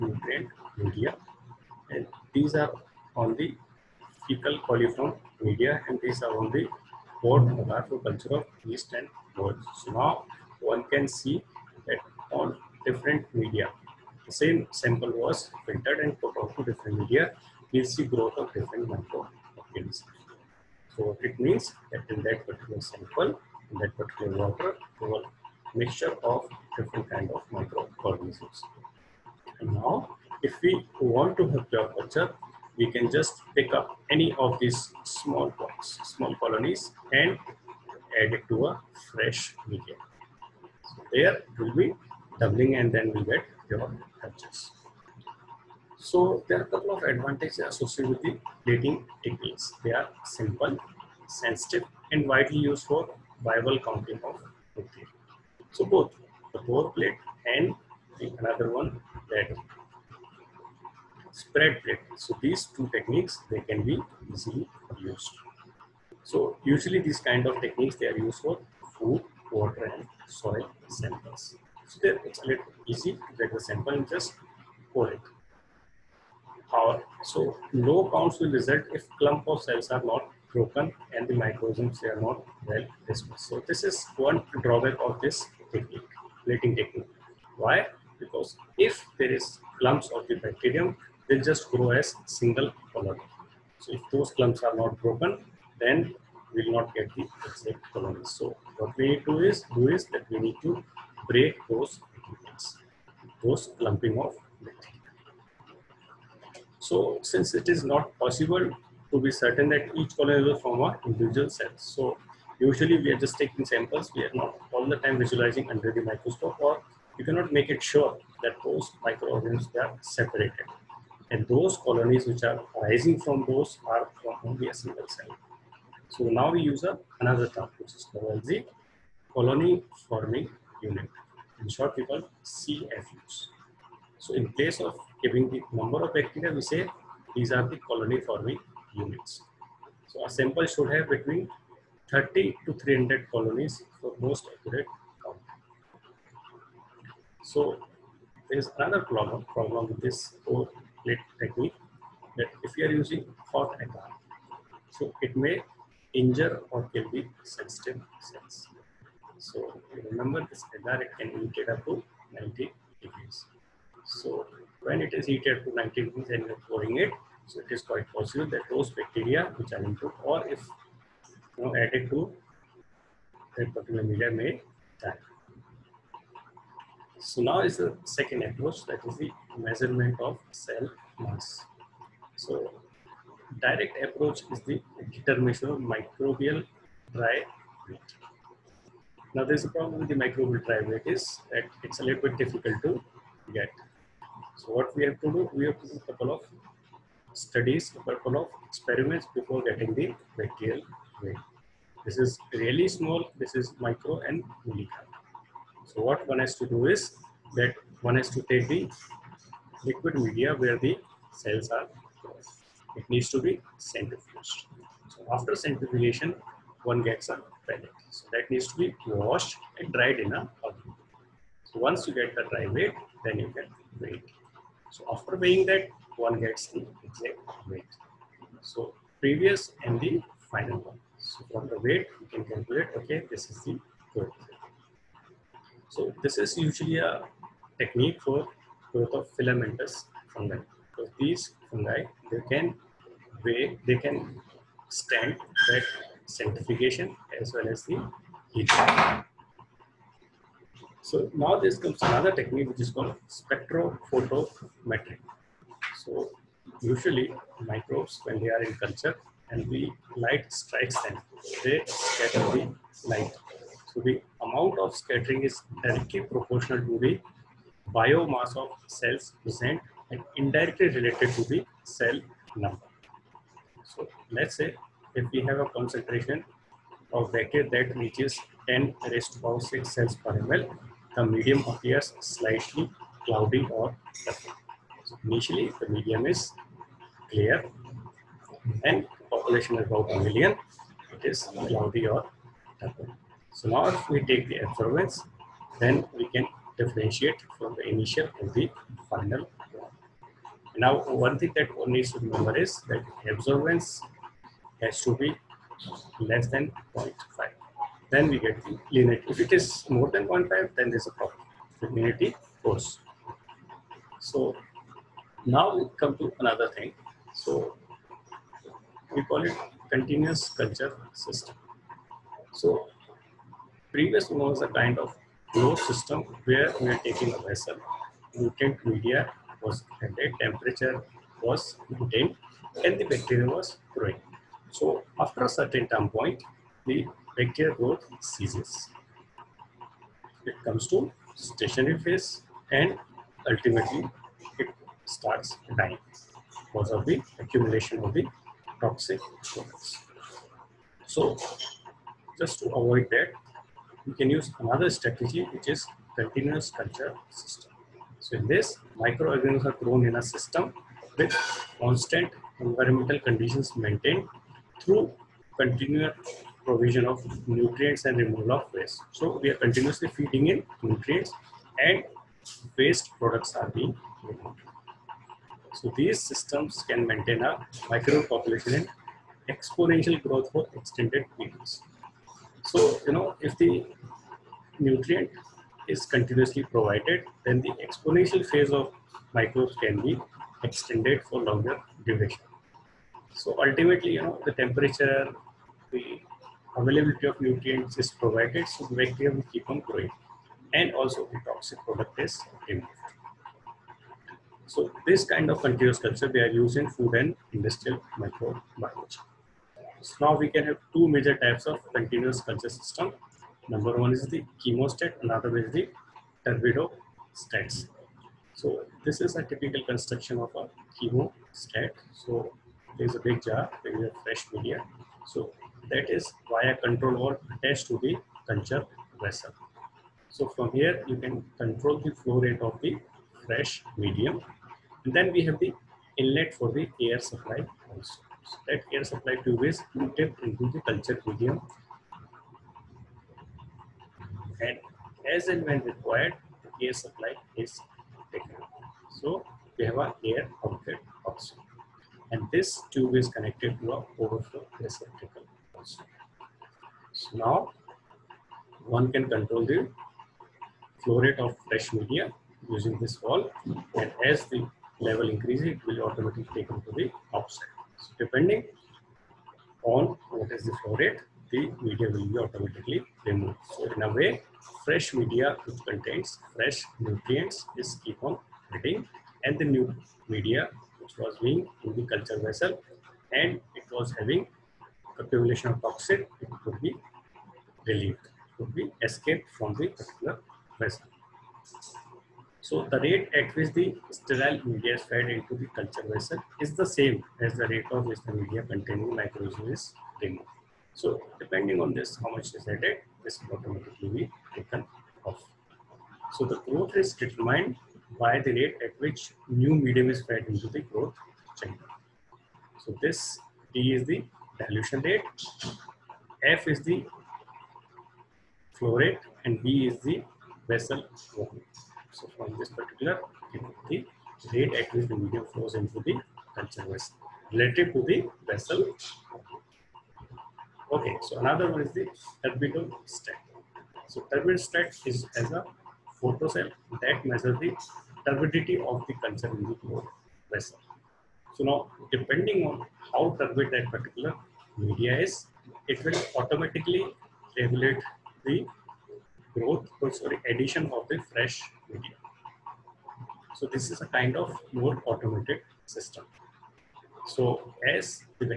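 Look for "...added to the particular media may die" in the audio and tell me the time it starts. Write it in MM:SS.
02:51.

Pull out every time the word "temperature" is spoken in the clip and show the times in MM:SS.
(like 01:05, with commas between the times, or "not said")
05:30, 06:34.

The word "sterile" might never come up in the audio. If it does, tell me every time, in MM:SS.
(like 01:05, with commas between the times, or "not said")
08:14.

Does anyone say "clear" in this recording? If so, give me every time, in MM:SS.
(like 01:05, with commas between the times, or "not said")
04:47.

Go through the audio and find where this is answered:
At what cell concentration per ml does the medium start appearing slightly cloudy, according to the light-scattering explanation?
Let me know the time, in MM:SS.
04:38.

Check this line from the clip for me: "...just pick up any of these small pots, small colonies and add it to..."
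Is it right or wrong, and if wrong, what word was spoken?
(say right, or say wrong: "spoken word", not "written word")
right.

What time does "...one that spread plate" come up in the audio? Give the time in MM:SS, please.
00:58.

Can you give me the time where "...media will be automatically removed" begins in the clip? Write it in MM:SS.
07:51.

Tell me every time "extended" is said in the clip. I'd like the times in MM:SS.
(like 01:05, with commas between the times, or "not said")
06:20, 06:30.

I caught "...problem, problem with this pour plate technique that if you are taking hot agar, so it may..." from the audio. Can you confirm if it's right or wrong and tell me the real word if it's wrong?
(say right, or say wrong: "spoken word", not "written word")
wrong: "using", not "taking".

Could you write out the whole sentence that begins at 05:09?
If it is more than 0.5, then there's a problem.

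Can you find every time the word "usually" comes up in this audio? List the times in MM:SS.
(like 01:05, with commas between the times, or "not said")
01:06, 01:52, 03:56, 04:16.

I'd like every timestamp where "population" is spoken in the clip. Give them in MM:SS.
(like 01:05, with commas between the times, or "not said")
04:49, 06:18.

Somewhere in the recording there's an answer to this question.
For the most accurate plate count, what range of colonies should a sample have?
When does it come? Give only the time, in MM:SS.
02:22.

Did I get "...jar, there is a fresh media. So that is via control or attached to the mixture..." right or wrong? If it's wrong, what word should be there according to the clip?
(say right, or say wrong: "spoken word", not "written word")
wrong: "culture", not "mixture".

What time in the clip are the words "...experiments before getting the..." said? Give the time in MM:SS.
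03:18.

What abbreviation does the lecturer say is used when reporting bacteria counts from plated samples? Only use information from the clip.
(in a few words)
CFUs.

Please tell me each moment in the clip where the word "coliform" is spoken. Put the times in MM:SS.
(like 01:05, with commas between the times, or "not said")
00:04.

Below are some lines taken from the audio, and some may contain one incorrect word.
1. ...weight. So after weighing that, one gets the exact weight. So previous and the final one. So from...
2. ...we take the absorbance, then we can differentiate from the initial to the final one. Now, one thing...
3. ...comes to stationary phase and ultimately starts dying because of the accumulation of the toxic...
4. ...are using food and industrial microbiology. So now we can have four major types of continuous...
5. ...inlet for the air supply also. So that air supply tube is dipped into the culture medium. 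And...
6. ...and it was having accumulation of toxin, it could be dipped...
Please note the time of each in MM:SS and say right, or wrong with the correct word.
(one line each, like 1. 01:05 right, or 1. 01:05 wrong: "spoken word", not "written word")
1. 03:44 right
2. 04:54 right
3. 05:40 right
4. 06:46 wrong: "two", not "four"
5. 07:16 right
6. 08:03 wrong: "relieved", not "dipped".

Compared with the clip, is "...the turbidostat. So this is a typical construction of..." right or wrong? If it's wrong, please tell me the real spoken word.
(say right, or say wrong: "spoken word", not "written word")
right.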